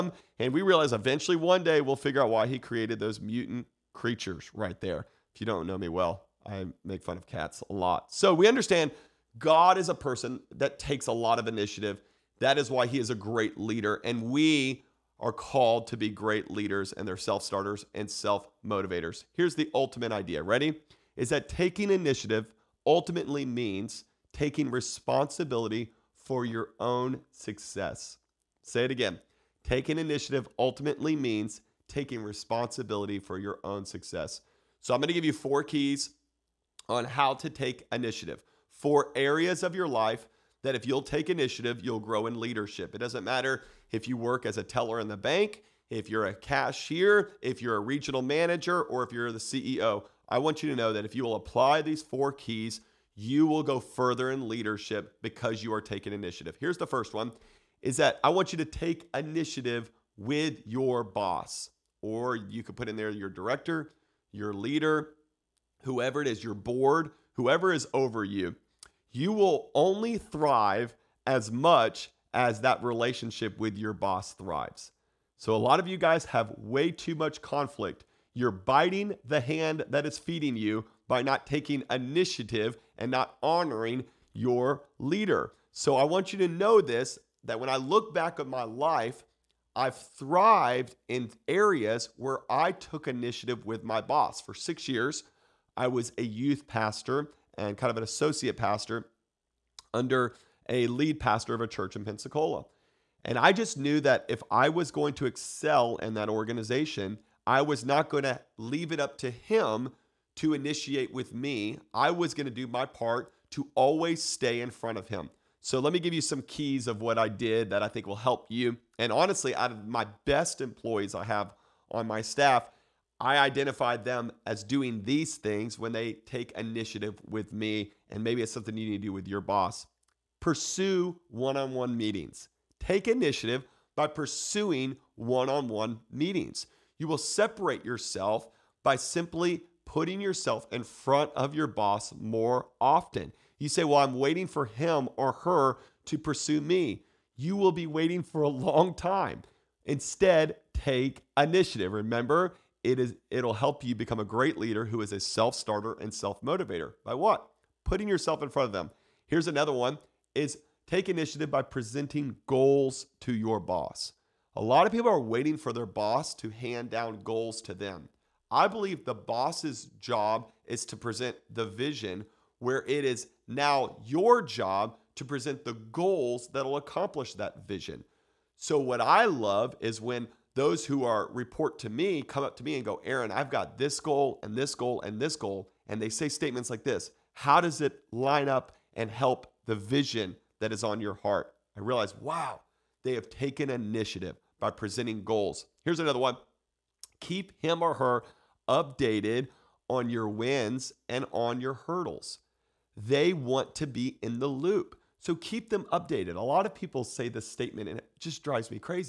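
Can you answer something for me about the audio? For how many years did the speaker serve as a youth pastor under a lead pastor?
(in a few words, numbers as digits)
6.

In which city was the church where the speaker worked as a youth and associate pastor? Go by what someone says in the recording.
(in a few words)
Pensacola.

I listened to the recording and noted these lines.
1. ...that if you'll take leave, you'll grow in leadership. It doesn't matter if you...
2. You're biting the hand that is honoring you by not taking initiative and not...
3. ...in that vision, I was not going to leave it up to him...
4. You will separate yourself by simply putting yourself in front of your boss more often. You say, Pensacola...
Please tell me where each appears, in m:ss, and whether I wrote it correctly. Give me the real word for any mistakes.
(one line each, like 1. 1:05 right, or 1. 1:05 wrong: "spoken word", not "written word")
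1. 0:40 wrong: "initiative", not "leave"
2. 1:18 wrong: "feeding", not "honoring"
3. 1:45 wrong: "organization", not "vision"
4. 2:16 wrong: "Well", not "Pensacola".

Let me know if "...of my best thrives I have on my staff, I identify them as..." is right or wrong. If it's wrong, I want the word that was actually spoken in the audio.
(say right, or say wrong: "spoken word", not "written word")
wrong: "employees", not "thrives".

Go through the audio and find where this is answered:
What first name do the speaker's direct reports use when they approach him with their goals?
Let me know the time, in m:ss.
3:03.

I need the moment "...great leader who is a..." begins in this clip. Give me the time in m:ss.
2:34.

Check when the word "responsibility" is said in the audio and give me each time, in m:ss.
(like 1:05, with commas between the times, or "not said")
0:24, 0:32.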